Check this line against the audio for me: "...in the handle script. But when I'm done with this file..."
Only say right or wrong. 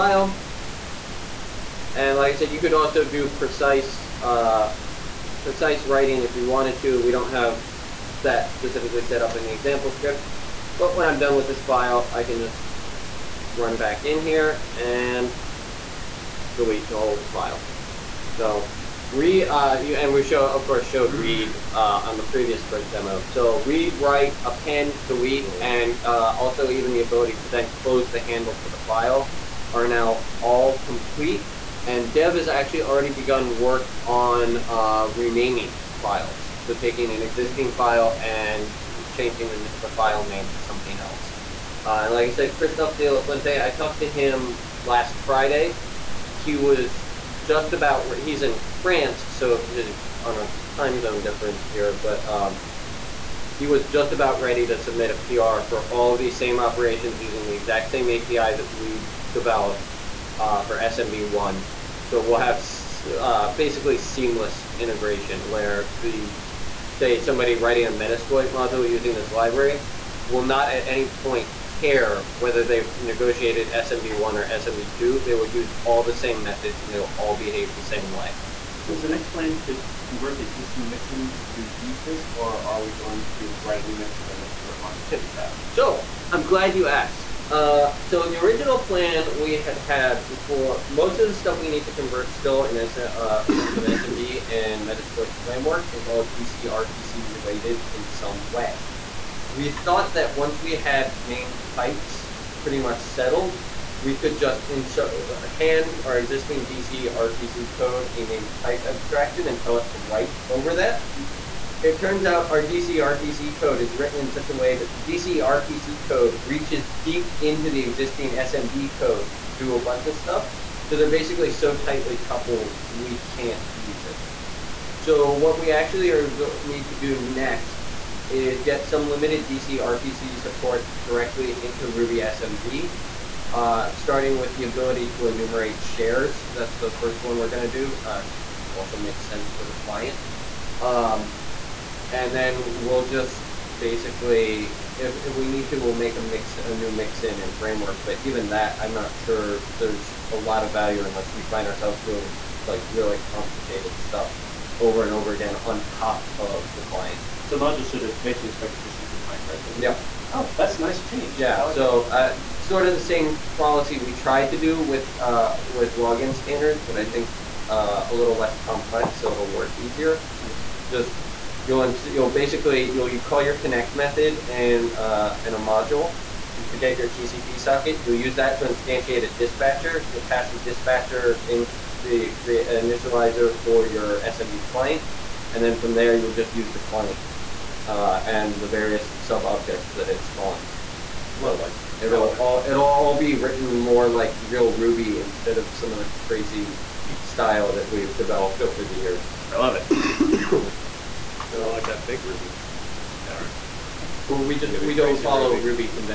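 wrong.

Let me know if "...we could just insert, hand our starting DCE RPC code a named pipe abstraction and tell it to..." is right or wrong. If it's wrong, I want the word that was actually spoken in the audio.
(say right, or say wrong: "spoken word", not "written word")
wrong: "existing", not "starting".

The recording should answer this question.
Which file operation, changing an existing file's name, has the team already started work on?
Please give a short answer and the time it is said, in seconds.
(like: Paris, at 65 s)
Renaming files, at 35 s.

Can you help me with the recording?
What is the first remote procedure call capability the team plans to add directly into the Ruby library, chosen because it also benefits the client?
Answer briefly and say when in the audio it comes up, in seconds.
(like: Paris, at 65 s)
Enumerate shares, at 135 s.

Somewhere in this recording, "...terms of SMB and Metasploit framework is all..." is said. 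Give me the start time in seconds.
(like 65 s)
93 s.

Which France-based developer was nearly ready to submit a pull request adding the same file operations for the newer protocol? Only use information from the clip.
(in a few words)
Christophe De La Fuente.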